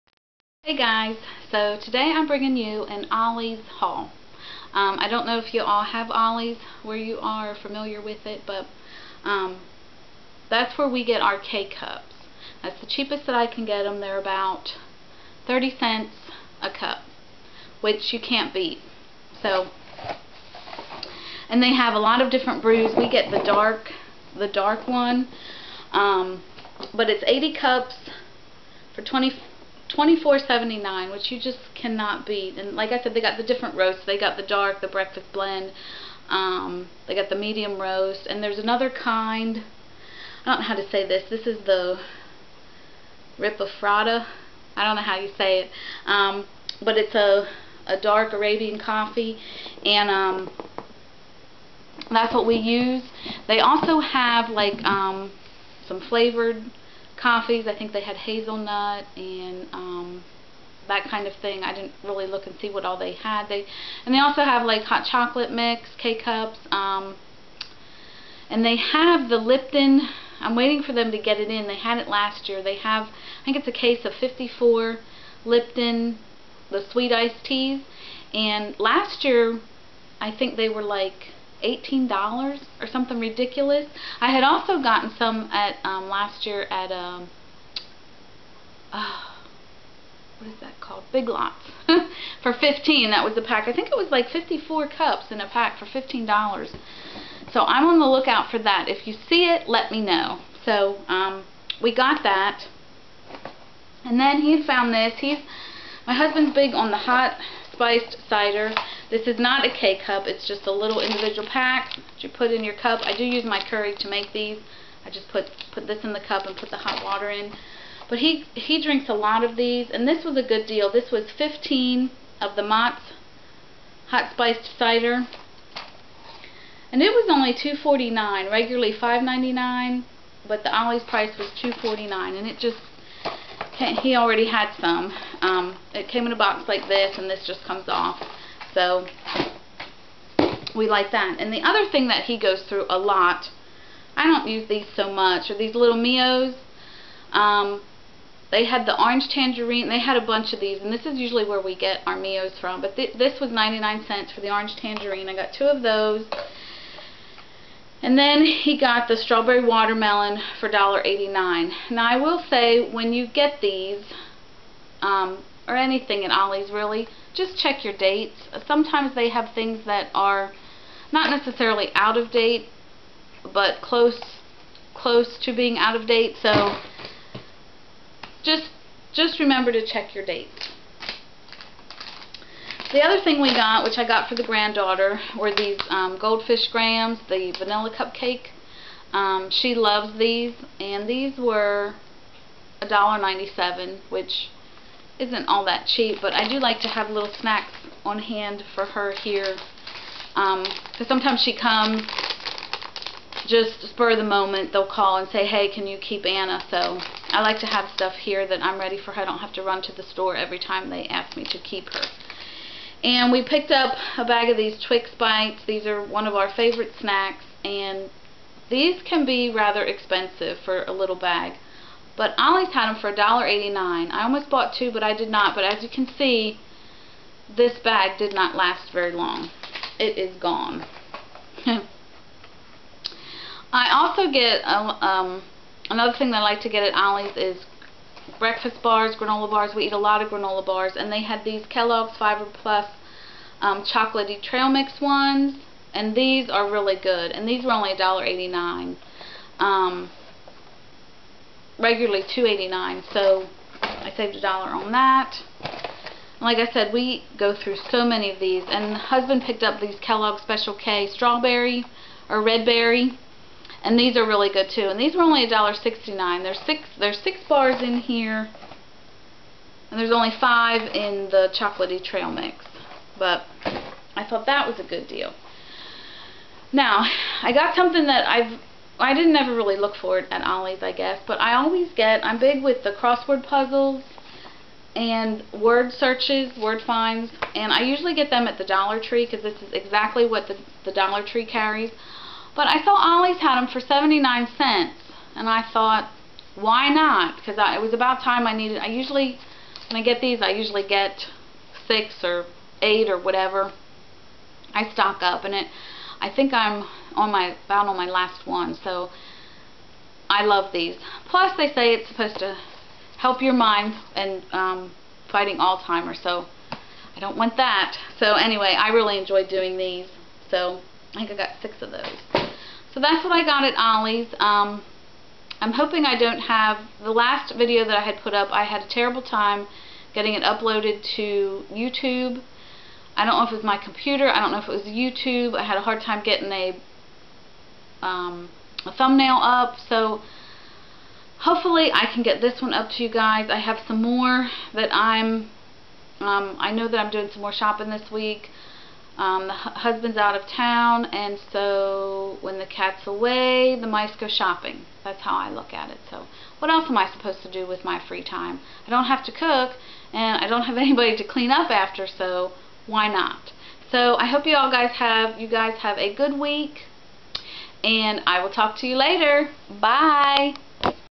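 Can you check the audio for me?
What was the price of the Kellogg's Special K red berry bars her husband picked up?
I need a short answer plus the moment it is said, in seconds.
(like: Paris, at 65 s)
$1.69, at 265 s.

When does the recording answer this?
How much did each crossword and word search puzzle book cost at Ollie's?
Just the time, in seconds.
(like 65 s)
293 s.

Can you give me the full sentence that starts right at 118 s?
But he, he drinks a lot of these, and this was a good deal.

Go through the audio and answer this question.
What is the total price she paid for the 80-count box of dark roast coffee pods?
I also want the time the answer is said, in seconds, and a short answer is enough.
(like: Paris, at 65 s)
$24.79, at 29 s.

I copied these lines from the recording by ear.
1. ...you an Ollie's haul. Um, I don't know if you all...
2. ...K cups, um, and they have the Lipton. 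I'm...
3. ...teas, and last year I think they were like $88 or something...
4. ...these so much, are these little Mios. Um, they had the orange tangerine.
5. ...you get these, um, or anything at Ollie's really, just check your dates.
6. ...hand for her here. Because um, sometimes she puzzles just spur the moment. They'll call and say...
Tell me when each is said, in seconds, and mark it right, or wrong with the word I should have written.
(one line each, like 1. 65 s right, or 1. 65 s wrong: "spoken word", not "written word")
1. 2 s right
2. 65 s right
3. 77 s wrong: "18", not "88"
4. 144 s right
5. 163 s right
6. 198 s wrong: "comes", not "puzzles".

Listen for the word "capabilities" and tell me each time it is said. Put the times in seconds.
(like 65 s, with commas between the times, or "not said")
not said.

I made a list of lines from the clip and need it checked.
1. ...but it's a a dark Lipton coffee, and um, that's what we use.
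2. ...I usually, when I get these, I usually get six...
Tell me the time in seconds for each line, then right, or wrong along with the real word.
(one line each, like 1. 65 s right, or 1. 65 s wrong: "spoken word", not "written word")
1. 46 s wrong: "Arabian", not "Lipton"
2. 298 s right.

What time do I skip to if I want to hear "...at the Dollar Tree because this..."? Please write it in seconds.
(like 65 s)
288 s.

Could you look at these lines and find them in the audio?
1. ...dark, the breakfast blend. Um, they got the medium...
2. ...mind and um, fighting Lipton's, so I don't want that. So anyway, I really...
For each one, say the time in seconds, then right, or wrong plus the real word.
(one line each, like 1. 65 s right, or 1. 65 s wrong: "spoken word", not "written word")
1. 34 s right
2. 313 s wrong: "Alzheimer", not "Lipton".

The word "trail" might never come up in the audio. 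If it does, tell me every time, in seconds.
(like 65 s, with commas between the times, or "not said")
244 s, 272 s.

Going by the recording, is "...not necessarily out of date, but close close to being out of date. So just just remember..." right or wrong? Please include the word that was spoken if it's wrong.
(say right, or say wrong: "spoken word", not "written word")
right.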